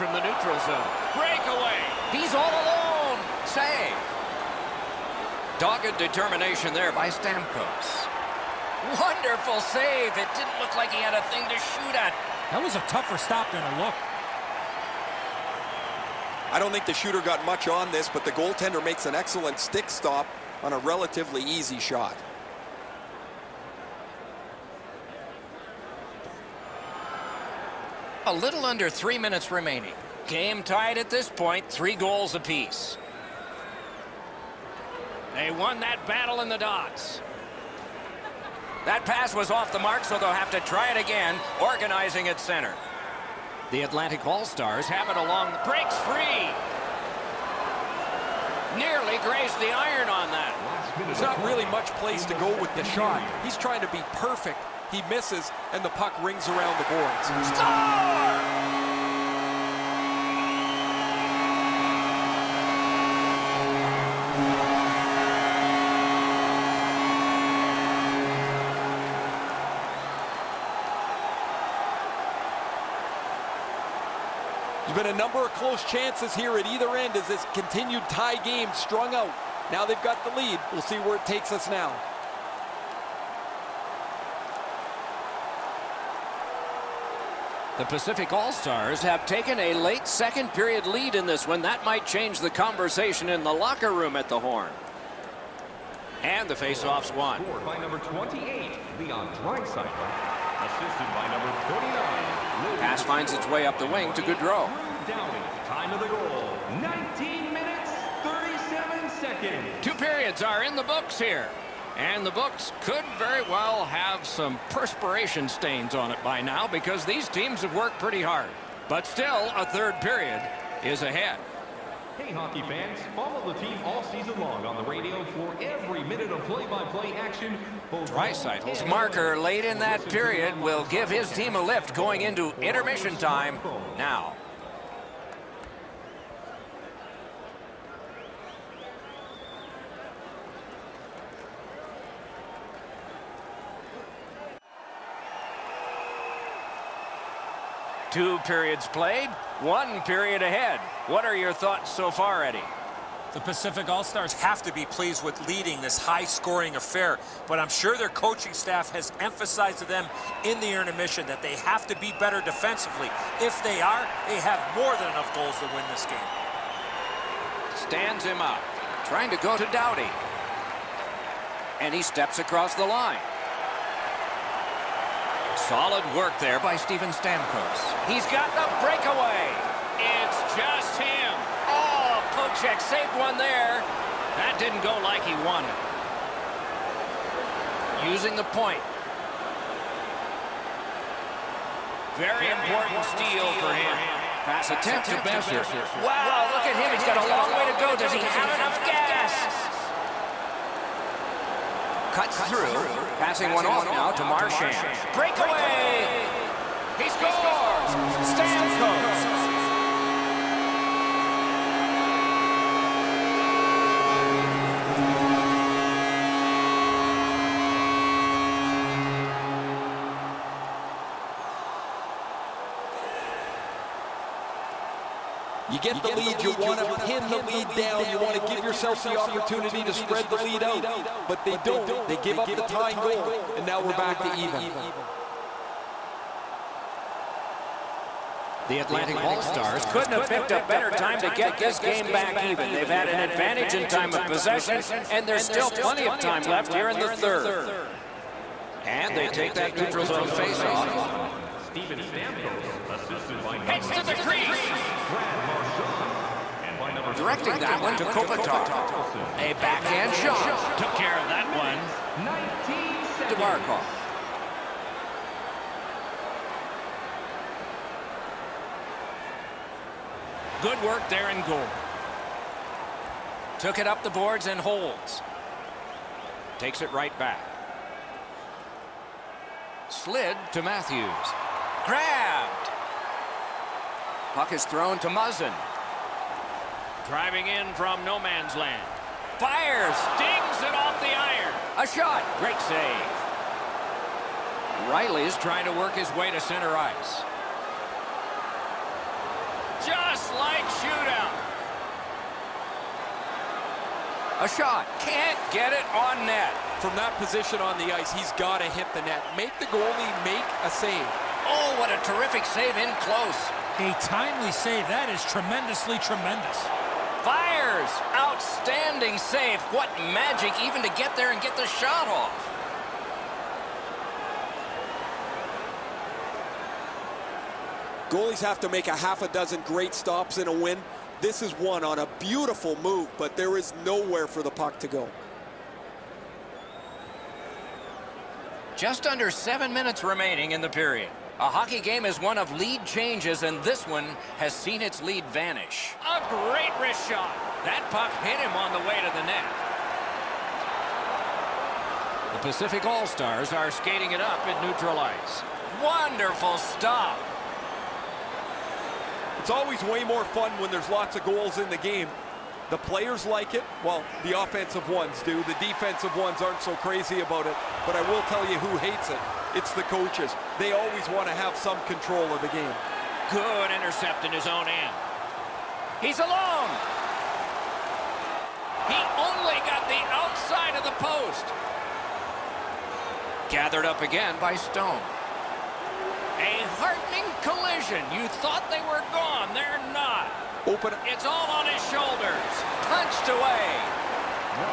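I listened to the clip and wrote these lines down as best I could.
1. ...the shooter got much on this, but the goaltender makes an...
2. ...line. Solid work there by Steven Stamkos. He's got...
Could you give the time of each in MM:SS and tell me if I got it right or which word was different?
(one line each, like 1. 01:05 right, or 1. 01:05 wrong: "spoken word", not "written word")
1. 00:16 right
2. 02:52 right.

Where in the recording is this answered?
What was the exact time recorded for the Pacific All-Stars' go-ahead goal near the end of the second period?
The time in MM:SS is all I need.
01:46.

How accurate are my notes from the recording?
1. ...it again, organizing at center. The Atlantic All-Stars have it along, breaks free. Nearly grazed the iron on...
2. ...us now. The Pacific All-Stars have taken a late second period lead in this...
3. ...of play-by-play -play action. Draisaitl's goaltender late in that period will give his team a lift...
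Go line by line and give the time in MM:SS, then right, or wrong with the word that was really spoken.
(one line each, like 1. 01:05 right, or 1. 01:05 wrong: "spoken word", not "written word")
1. 00:40 right
2. 01:21 right
3. 02:06 wrong: "marker", not "goaltender".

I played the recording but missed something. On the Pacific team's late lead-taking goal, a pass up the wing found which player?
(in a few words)
Goodrow.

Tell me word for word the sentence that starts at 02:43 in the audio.
If they are, they have more than enough goals to win this game.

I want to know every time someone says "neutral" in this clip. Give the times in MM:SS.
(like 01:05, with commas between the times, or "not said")
00:00, 04:09, 05:54.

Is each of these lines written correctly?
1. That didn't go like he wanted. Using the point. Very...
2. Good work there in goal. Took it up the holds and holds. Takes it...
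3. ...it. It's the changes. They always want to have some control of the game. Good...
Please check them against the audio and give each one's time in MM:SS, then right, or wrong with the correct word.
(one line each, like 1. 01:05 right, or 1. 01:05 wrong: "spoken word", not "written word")
1. 03:04 right
2. 04:30 wrong: "boards", not "holds"
3. 06:09 wrong: "coaches", not "changes".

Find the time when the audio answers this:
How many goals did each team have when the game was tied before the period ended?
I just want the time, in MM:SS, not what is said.
00:31.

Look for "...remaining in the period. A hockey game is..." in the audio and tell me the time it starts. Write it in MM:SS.
05:40.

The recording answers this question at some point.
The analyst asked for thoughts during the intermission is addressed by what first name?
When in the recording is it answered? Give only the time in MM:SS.
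02:32.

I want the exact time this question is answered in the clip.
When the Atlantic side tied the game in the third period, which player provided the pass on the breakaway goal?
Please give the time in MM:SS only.
04:15.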